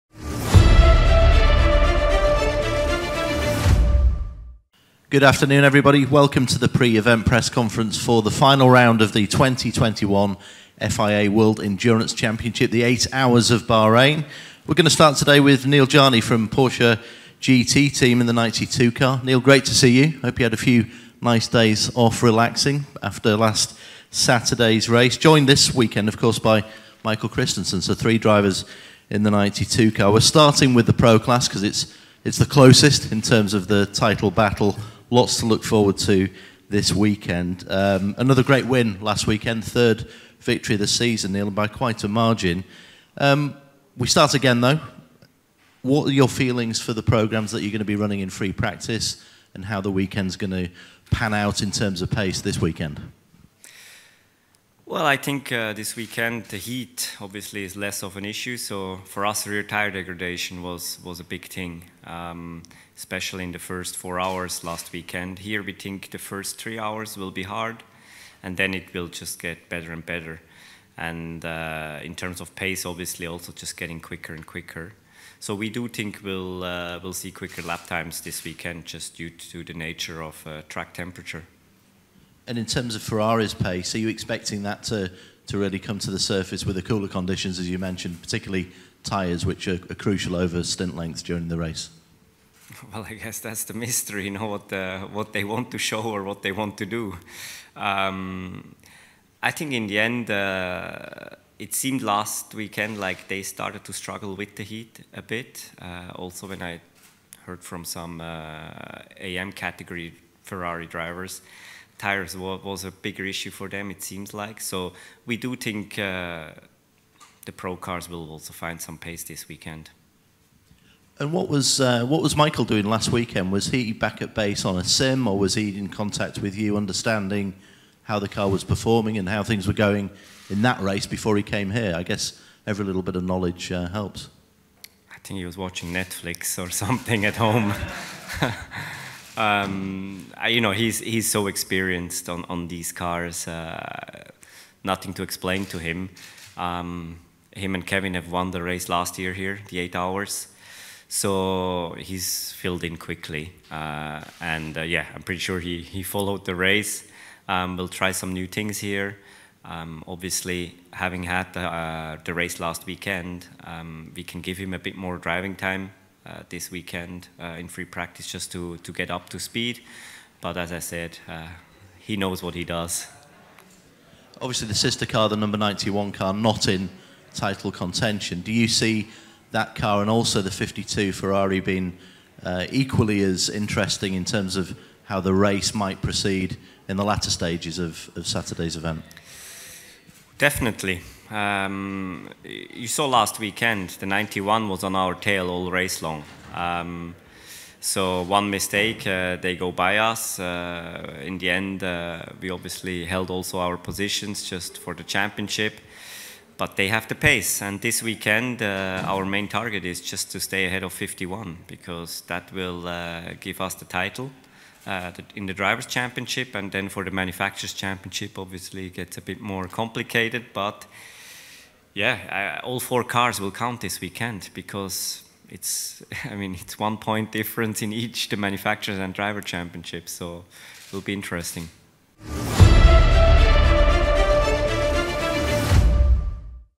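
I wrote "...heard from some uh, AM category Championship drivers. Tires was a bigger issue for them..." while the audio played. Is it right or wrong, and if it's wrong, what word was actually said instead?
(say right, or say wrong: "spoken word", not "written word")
wrong: "Ferrari", not "Championship".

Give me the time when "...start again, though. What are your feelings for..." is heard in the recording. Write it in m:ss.
0:44.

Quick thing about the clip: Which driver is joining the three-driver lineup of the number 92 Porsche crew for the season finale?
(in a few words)
Michael Christensen.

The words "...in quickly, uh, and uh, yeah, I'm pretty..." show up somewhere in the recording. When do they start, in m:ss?
2:32.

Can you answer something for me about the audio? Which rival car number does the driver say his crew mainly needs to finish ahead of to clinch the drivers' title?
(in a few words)
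51.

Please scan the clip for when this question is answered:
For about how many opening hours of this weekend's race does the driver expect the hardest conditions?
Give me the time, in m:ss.
1:06.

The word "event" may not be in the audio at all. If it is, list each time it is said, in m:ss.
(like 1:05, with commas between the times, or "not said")
0:06, 3:08.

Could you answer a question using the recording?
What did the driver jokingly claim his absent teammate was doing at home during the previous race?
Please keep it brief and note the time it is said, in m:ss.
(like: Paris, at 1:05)
Watching Netflix, at 2:15.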